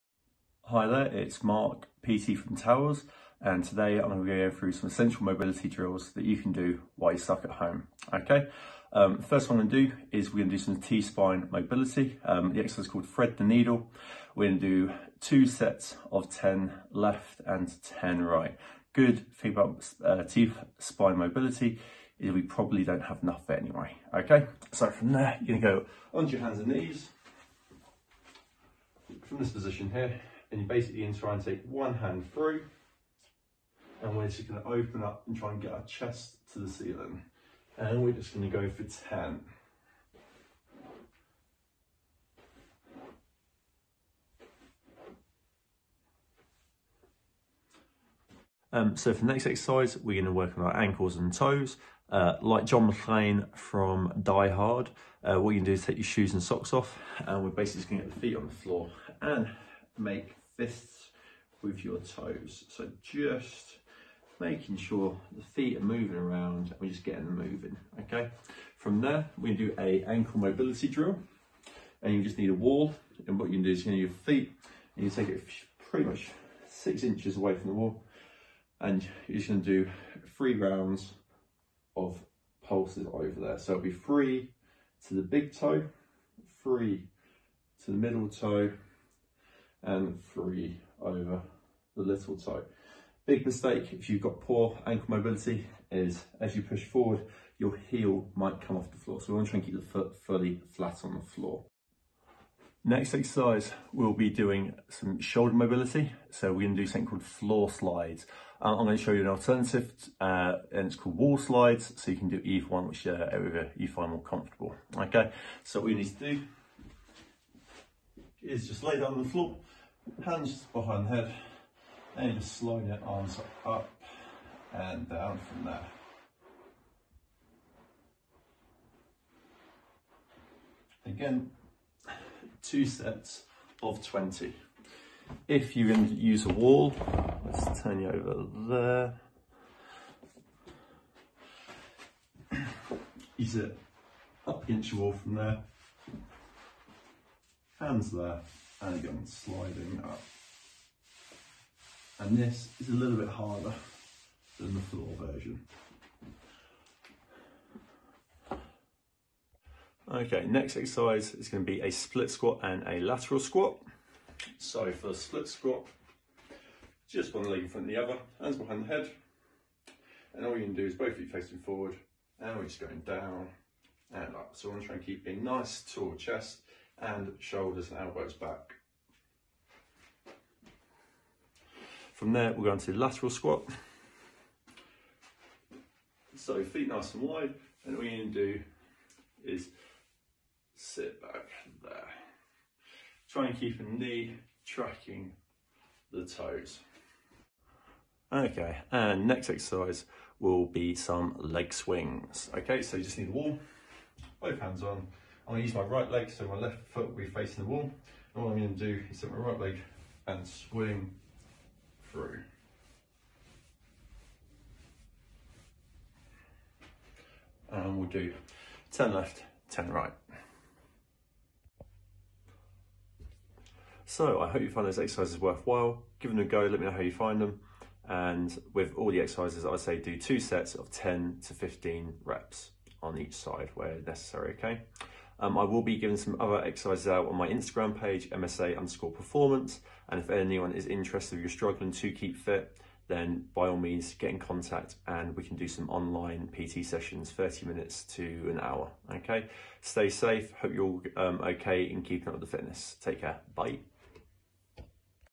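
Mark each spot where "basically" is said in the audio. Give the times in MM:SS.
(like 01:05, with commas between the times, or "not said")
00:30, 00:57.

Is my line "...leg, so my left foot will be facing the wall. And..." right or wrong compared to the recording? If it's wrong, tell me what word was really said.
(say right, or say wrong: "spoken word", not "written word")
right.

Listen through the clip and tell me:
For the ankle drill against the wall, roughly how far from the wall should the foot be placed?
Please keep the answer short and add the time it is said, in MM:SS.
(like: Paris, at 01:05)
6 inches, at 01:16.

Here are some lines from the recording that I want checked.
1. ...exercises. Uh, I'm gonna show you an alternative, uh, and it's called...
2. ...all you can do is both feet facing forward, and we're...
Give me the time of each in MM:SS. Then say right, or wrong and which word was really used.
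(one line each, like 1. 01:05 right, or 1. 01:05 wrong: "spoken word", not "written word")
1. 01:47 wrong: "slides", not "exercises"
2. 02:50 right.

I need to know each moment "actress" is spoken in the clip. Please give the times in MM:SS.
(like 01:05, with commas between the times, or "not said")
not said.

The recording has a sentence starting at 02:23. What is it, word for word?
Use it up against your wall from there hands there, and again, sliding up.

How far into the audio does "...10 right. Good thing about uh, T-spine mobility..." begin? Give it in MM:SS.
00:17.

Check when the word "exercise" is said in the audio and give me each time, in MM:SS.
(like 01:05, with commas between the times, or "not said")
00:12, 00:49, 01:43, 02:40, 03:19, 03:44, 03:49, 03:56.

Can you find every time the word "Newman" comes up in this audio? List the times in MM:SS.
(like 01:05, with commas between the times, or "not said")
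not said.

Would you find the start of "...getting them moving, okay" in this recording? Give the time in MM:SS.
01:07.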